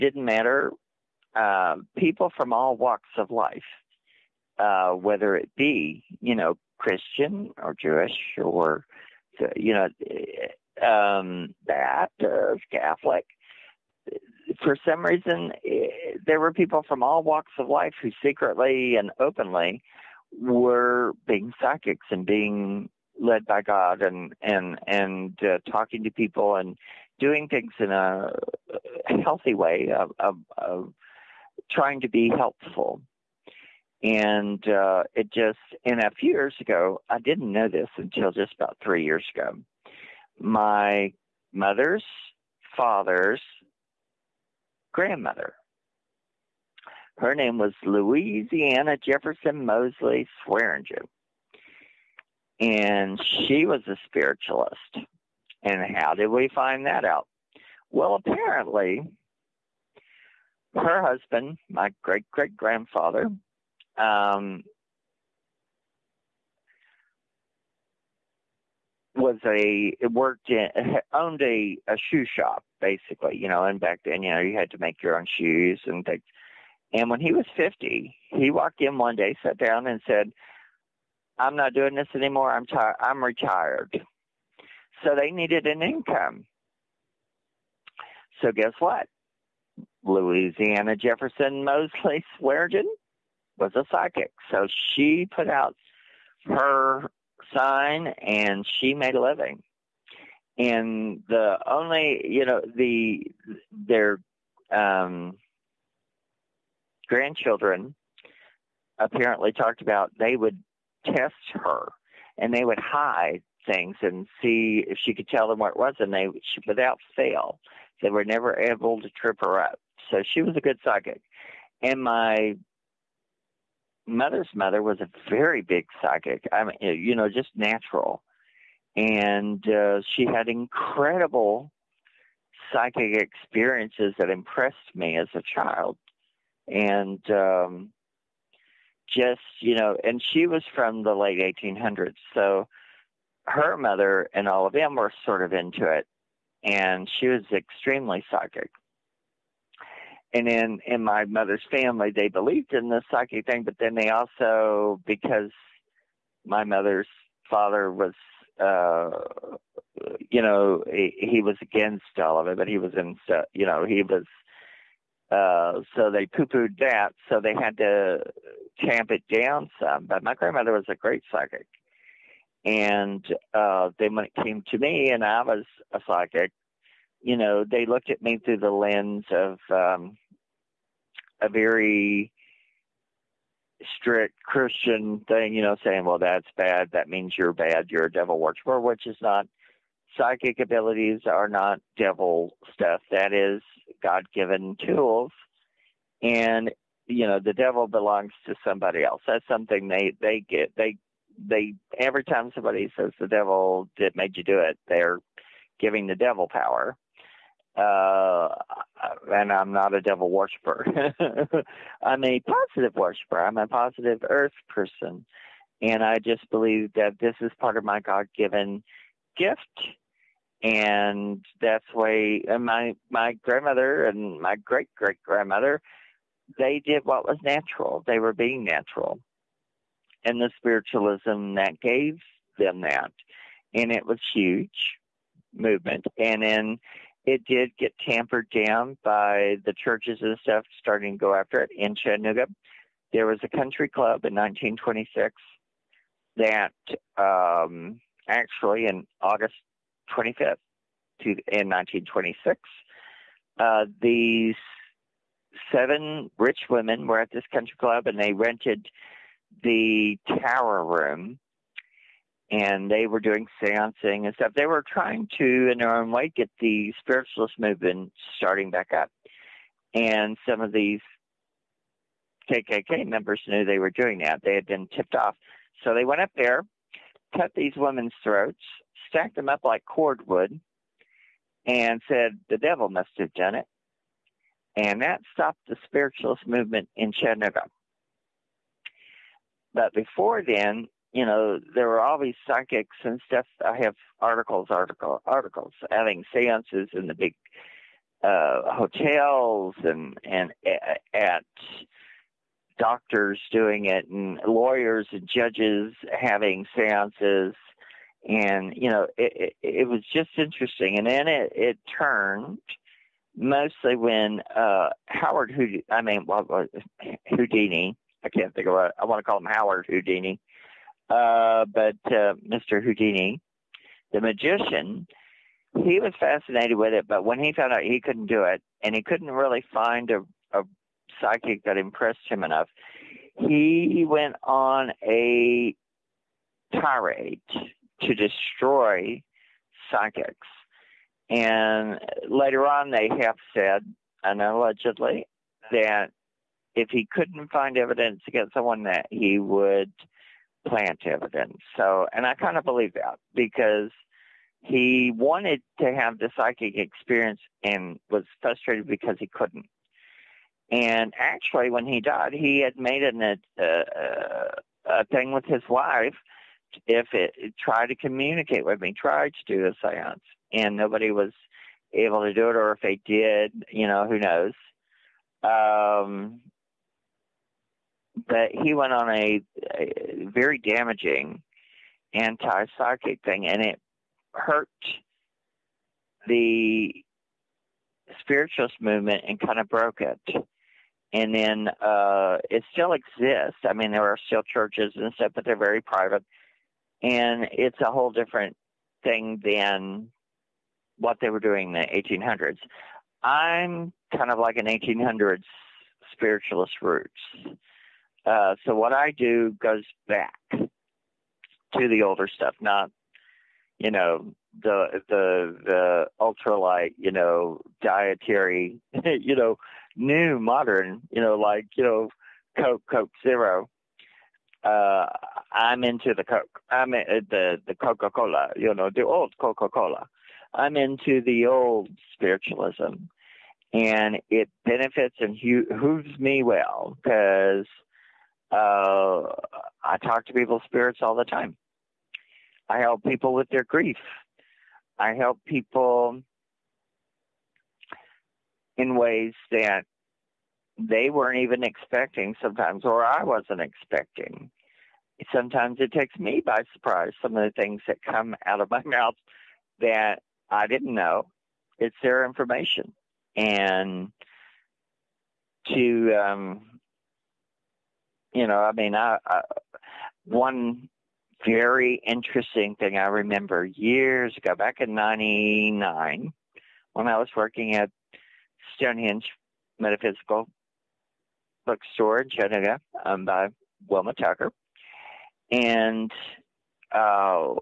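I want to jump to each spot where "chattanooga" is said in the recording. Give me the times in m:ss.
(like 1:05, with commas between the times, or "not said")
4:01, 4:47, 8:02.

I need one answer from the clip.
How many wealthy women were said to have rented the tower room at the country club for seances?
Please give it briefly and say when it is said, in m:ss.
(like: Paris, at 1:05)
7, at 4:15.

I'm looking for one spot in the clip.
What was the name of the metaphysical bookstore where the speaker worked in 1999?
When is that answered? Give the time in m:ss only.
7:58.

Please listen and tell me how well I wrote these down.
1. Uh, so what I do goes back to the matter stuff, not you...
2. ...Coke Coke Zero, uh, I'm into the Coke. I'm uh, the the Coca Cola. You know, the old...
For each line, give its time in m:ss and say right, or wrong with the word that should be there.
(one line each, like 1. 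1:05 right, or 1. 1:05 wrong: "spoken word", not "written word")
1. 6:48 wrong: "older", not "matter"
2. 7:02 right.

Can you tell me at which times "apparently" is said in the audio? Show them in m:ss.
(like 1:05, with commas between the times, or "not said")
0:58, 1:48.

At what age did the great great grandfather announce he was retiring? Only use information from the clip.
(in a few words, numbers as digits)
50.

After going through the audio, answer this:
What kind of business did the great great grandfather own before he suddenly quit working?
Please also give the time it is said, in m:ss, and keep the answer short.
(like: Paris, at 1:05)
shoe shop, at 1:12.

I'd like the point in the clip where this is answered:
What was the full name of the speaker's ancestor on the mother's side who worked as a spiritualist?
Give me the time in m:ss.
0:47.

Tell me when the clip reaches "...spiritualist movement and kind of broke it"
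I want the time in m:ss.
6:28.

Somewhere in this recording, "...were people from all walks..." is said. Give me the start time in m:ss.
0:16.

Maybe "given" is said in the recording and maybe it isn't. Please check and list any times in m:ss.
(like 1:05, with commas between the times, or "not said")
3:14, 3:38.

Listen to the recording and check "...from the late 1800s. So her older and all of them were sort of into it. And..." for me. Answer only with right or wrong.
wrong.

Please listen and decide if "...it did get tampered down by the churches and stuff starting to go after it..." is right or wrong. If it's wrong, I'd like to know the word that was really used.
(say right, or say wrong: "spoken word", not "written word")
right.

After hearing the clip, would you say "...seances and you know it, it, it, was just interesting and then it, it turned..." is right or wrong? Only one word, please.
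right.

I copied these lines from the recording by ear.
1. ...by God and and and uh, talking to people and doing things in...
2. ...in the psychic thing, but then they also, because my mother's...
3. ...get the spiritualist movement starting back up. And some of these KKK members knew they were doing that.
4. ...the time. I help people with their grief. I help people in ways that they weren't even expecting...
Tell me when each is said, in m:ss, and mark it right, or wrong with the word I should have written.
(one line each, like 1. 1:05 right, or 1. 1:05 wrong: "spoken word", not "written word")
1. 0:23 right
2. 2:32 right
3. 4:26 right
4. 7:21 right.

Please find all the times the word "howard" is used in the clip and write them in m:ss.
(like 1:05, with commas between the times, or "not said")
5:15, 5:19.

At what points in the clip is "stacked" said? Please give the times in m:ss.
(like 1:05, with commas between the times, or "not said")
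4:39.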